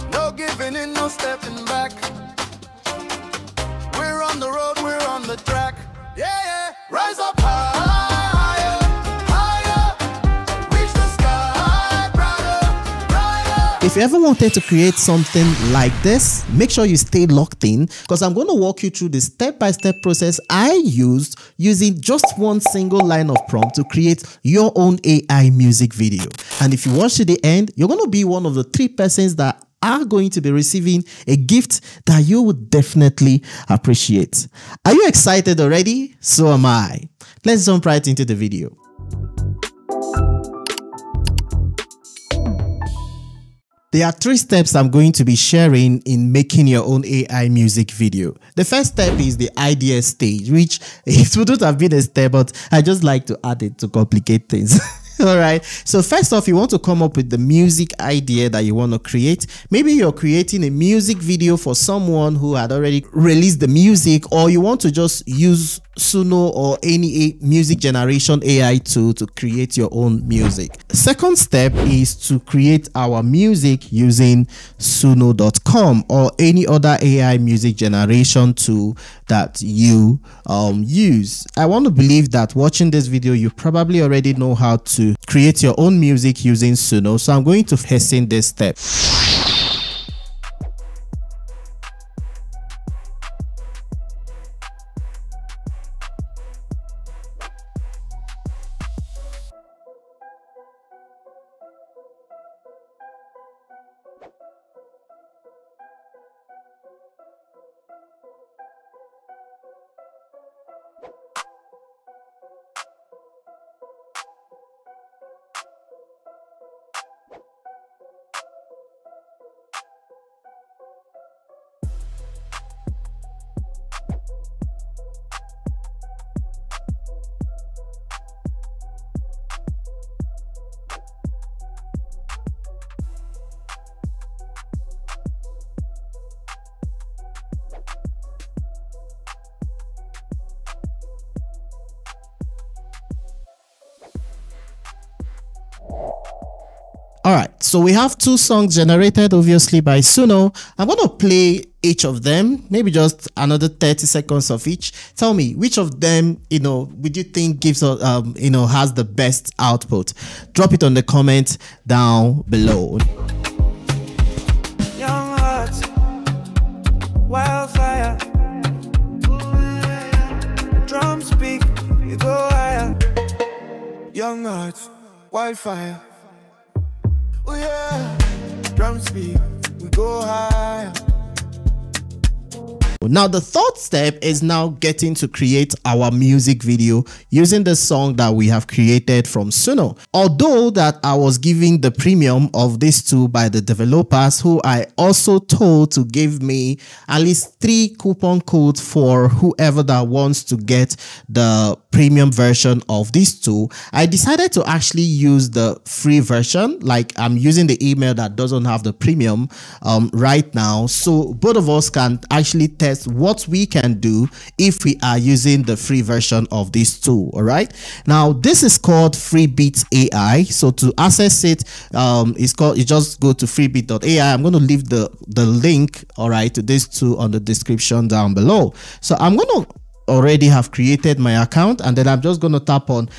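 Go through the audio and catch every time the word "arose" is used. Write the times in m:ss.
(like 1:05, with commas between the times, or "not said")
not said.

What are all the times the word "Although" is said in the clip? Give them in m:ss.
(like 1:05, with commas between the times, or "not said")
3:10.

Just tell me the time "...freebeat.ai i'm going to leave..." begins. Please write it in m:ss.
3:43.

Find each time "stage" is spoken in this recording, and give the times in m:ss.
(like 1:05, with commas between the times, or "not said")
0:50.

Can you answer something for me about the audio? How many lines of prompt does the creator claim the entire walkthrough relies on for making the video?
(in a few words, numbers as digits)
1.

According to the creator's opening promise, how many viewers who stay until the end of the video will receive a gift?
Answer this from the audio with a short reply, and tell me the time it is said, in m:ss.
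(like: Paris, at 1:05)
3, at 0:28.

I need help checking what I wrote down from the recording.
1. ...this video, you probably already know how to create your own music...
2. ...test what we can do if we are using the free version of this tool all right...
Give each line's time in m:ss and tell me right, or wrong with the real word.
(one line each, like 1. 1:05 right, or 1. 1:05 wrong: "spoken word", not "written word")
1. 1:22 right
2. 3:32 right.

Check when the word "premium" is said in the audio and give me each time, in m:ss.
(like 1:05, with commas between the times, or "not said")
3:11, 3:21, 3:28.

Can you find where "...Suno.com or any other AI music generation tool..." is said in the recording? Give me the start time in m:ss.
1:14.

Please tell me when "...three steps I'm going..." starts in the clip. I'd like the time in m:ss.
0:44.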